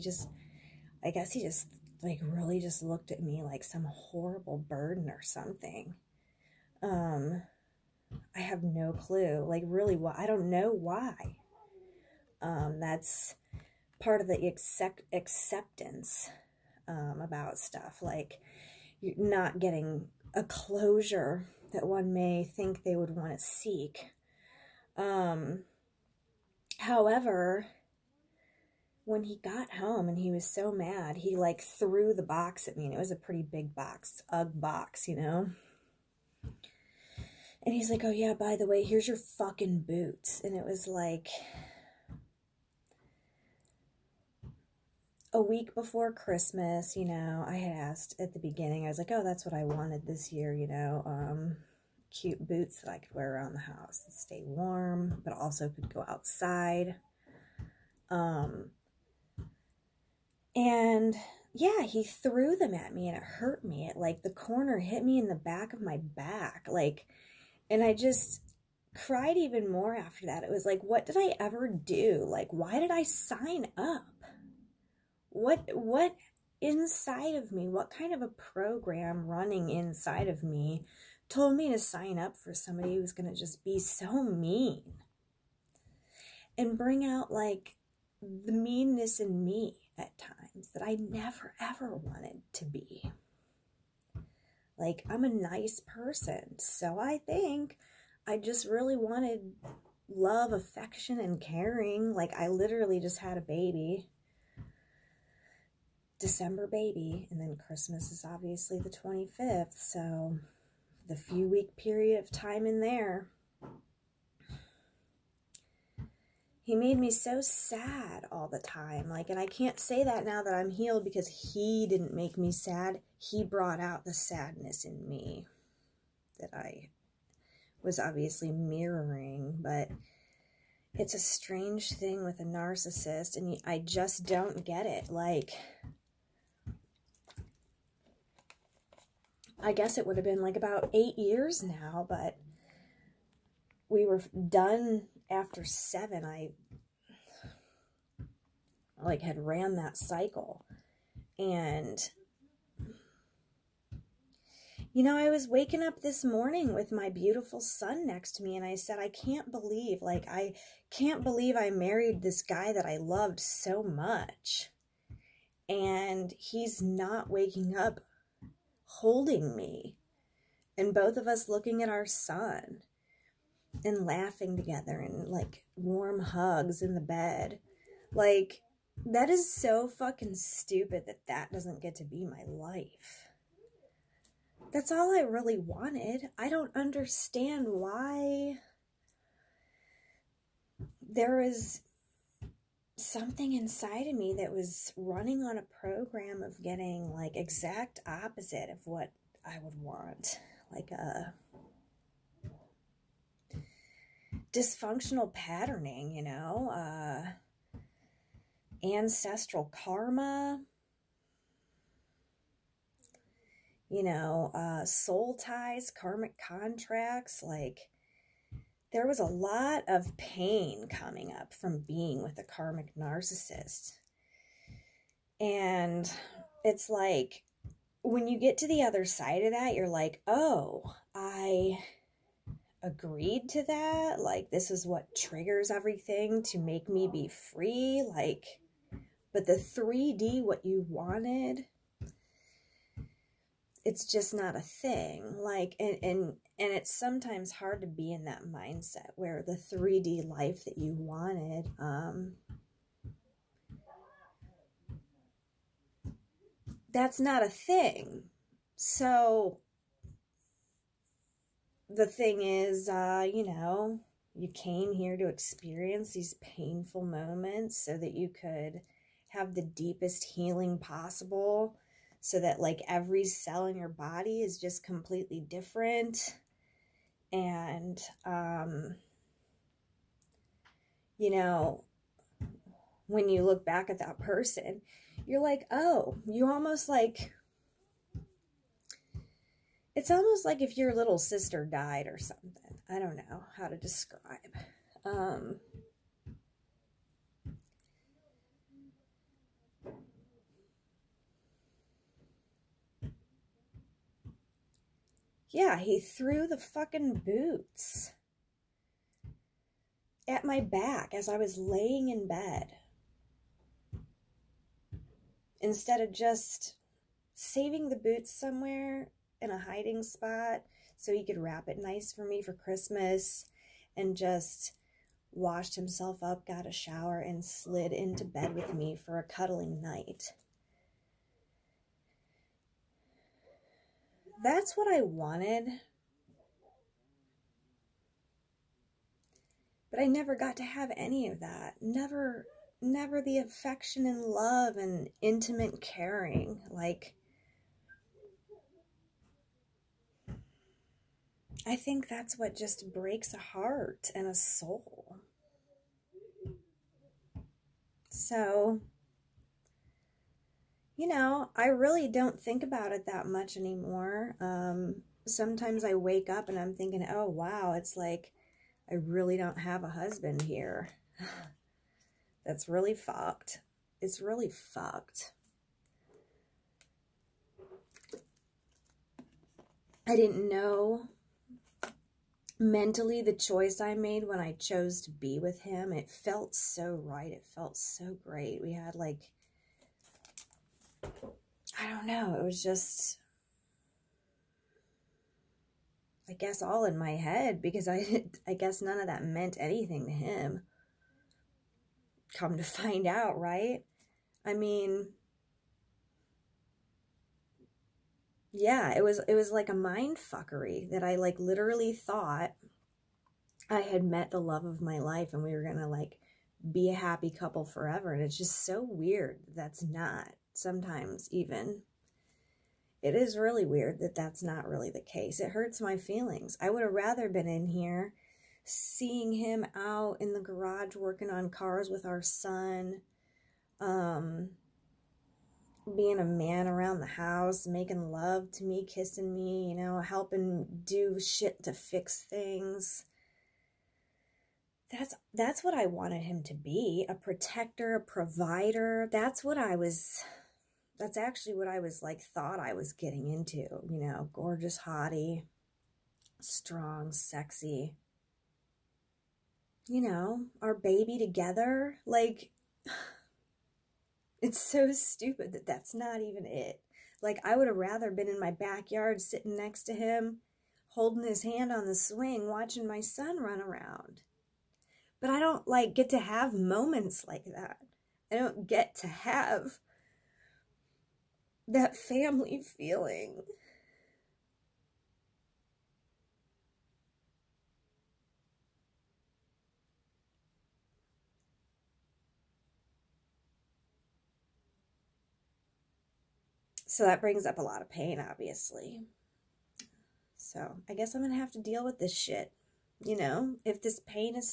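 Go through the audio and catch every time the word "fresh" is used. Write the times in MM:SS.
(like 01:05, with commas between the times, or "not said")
not said.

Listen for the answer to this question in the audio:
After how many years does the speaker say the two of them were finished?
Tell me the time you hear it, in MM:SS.
02:25.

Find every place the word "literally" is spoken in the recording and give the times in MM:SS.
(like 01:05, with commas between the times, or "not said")
01:42, 06:51.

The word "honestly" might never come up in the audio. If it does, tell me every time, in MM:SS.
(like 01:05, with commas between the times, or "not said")
not said.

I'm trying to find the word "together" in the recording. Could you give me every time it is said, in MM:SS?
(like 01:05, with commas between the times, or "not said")
02:54, 07:41.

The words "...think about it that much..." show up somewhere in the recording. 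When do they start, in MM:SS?
06:02.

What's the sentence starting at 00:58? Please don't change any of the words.
Um, and yeah, he threw them at me and it hurt me.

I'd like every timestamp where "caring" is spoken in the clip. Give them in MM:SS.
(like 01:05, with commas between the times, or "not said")
01:41, 05:45.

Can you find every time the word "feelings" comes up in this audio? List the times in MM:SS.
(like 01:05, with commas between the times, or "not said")
07:05, 08:02.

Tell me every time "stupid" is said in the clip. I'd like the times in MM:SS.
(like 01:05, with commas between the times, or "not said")
03:00, 07:44.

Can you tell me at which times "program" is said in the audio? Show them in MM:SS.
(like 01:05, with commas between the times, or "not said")
01:18, 03:15.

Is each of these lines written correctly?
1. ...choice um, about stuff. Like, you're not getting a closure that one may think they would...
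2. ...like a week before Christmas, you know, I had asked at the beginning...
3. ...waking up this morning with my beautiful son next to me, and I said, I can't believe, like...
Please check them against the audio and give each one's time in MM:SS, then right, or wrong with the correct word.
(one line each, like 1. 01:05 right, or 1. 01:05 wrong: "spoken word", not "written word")
1. 00:15 wrong: "acceptance", not "choice"
2. 00:40 right
3. 02:35 right.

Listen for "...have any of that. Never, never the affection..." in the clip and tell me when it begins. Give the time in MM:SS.
05:40.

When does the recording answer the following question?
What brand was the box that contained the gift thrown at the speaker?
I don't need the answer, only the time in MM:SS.
00:34.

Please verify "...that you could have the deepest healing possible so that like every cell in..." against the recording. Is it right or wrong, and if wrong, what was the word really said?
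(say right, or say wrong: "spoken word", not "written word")
right.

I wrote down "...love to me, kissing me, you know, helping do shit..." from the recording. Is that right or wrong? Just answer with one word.
right.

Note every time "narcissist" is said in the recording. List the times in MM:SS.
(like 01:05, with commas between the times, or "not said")
02:12, 03:42.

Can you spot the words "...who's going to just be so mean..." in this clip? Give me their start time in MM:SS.
01:22.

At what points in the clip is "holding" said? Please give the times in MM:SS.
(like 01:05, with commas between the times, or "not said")
02:48, 07:50.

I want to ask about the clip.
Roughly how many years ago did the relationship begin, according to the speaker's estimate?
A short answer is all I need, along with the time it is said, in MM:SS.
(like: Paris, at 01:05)
8, at 02:20.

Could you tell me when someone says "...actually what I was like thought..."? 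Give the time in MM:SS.
07:31.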